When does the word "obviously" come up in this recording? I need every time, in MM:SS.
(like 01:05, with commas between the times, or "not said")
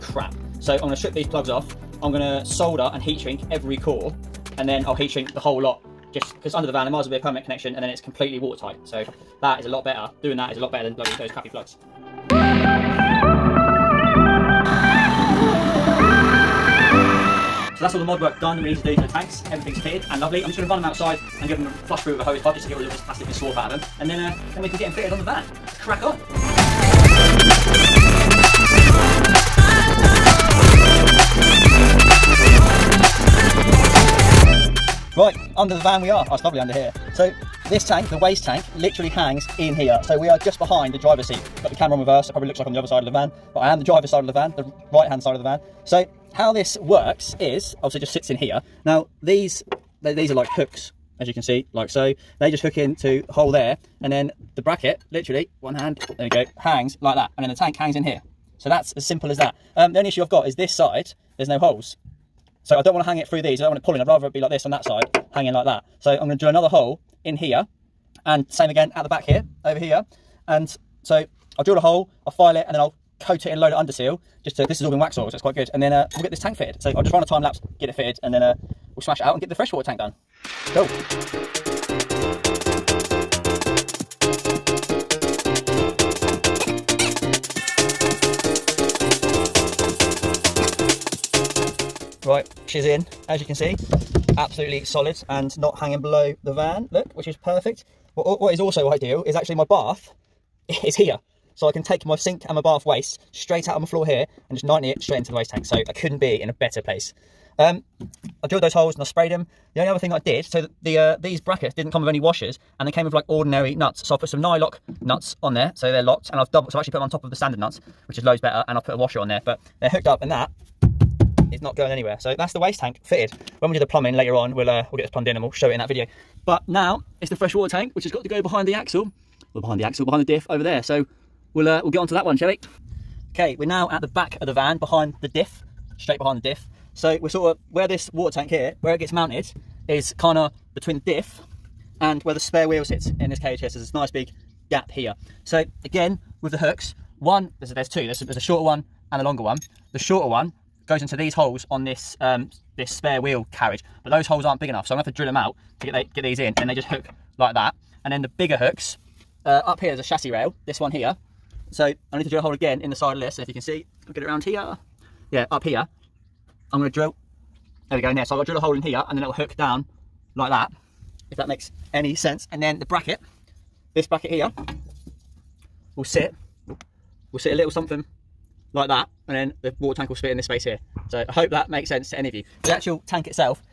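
00:47.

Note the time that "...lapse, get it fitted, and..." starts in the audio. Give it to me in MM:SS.
01:17.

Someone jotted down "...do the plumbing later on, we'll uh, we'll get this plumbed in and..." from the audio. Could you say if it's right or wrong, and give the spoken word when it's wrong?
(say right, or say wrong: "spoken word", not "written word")
right.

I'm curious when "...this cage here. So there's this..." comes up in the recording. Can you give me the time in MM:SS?
02:23.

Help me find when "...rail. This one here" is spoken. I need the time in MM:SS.
02:40.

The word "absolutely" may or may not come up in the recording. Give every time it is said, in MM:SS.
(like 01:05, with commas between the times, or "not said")
01:34.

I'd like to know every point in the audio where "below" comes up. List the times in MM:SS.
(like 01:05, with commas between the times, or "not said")
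01:36.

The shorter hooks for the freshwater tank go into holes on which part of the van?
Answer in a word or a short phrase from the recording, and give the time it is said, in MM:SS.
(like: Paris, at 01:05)
Spare wheel carriage, at 02:32.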